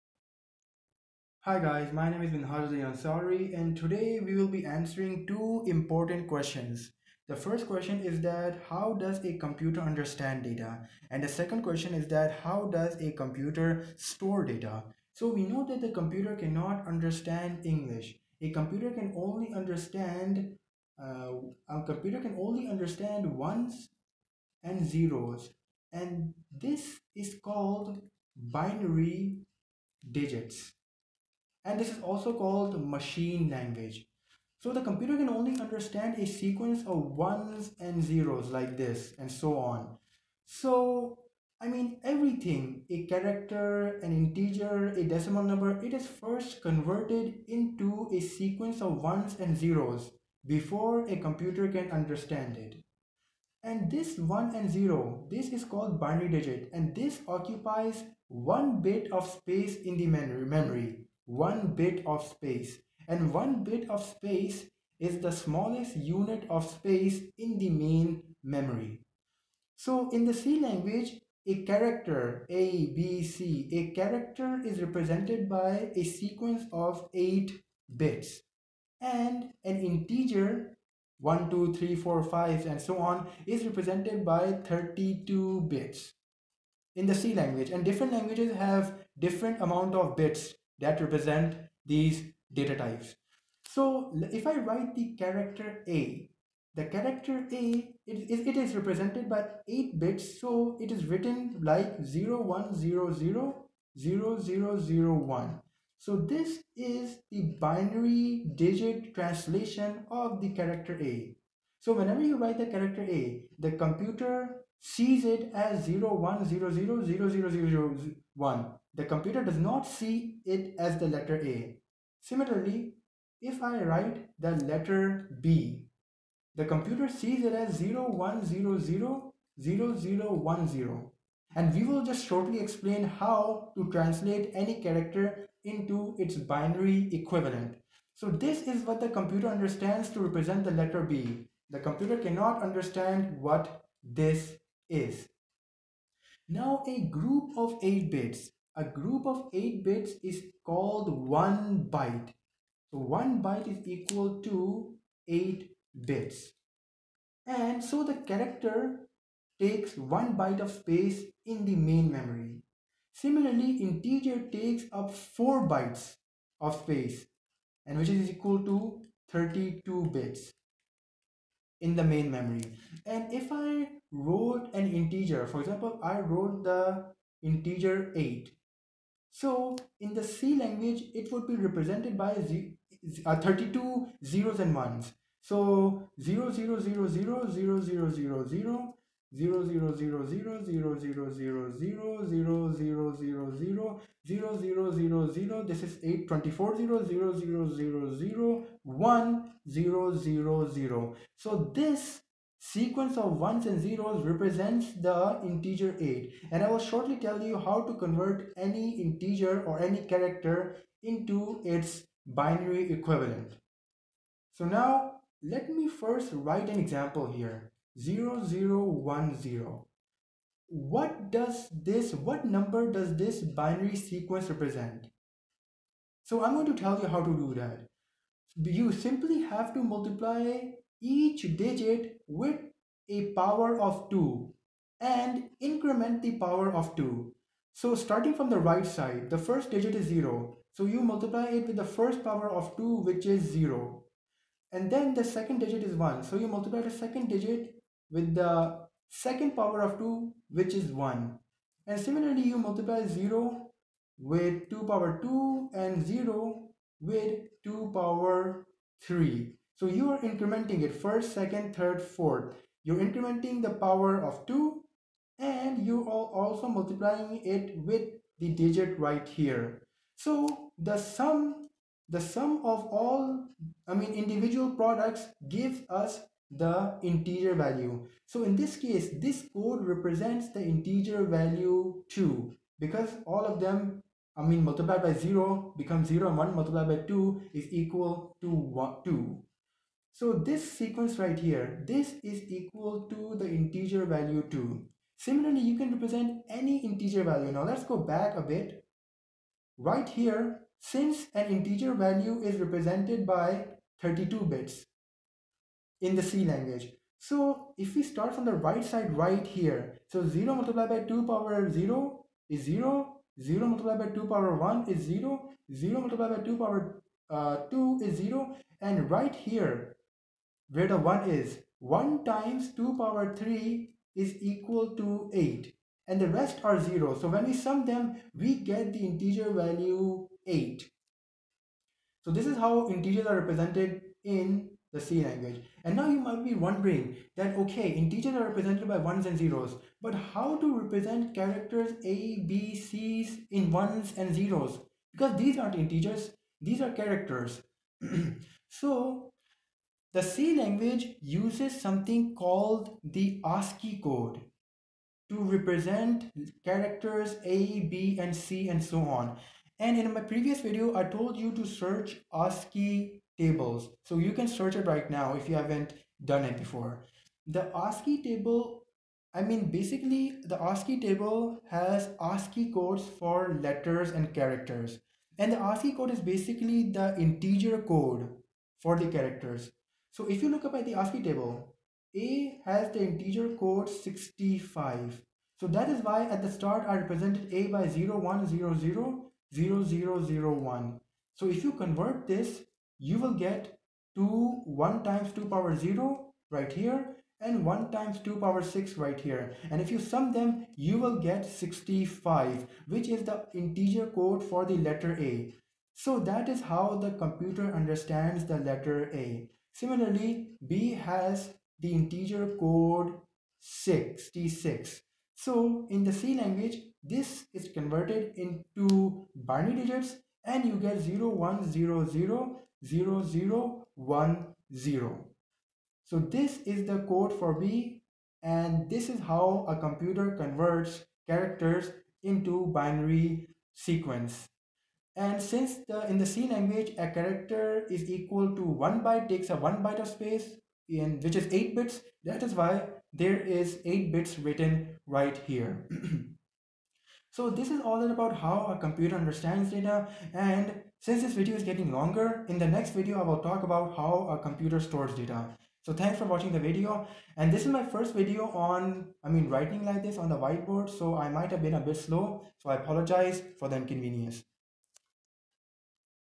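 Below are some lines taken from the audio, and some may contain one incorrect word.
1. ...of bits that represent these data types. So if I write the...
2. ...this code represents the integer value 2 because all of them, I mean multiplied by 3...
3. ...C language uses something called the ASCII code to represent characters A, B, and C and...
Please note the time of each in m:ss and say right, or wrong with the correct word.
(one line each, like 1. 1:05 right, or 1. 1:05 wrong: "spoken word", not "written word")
1. 1:29 right
2. 4:39 wrong: "0", not "3"
3. 5:50 right.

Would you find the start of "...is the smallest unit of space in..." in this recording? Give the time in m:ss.
1:04.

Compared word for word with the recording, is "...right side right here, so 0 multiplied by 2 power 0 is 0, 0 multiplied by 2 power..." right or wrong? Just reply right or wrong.
right.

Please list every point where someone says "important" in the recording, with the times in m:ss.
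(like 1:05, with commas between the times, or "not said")
0:05.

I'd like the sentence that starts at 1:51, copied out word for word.
So whenever you write the character A, the computer sees it as 01000001.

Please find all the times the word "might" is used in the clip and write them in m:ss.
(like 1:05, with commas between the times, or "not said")
5:36, 7:41.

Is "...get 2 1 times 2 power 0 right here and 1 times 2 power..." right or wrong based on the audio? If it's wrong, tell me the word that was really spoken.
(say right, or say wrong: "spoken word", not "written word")
right.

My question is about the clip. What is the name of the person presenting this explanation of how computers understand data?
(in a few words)
Minhajuddin Ansari.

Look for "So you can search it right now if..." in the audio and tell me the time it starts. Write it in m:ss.
6:04.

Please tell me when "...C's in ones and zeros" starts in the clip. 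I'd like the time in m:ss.
5:42.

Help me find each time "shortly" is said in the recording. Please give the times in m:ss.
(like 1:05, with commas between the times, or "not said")
2:12, 3:26.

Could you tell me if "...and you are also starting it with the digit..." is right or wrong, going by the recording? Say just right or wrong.
wrong.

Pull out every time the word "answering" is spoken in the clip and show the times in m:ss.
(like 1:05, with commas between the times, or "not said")
0:04.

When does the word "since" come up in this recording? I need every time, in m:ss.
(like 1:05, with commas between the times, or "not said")
5:00, 7:15, 7:31.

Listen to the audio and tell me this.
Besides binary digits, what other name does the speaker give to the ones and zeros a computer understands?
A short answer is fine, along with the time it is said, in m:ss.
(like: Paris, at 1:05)
machine language, at 0:32.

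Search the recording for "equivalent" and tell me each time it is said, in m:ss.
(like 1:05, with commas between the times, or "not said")
2:17, 3:32.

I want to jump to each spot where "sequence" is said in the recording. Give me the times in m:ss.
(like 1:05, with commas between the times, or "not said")
0:36, 0:48, 1:16, 3:22, 3:43, 4:50, 7:13.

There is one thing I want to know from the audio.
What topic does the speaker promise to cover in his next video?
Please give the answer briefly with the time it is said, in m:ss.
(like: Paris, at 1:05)
how a computer stores data, at 7:33.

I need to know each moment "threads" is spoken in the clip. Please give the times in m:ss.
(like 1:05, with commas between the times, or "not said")
not said.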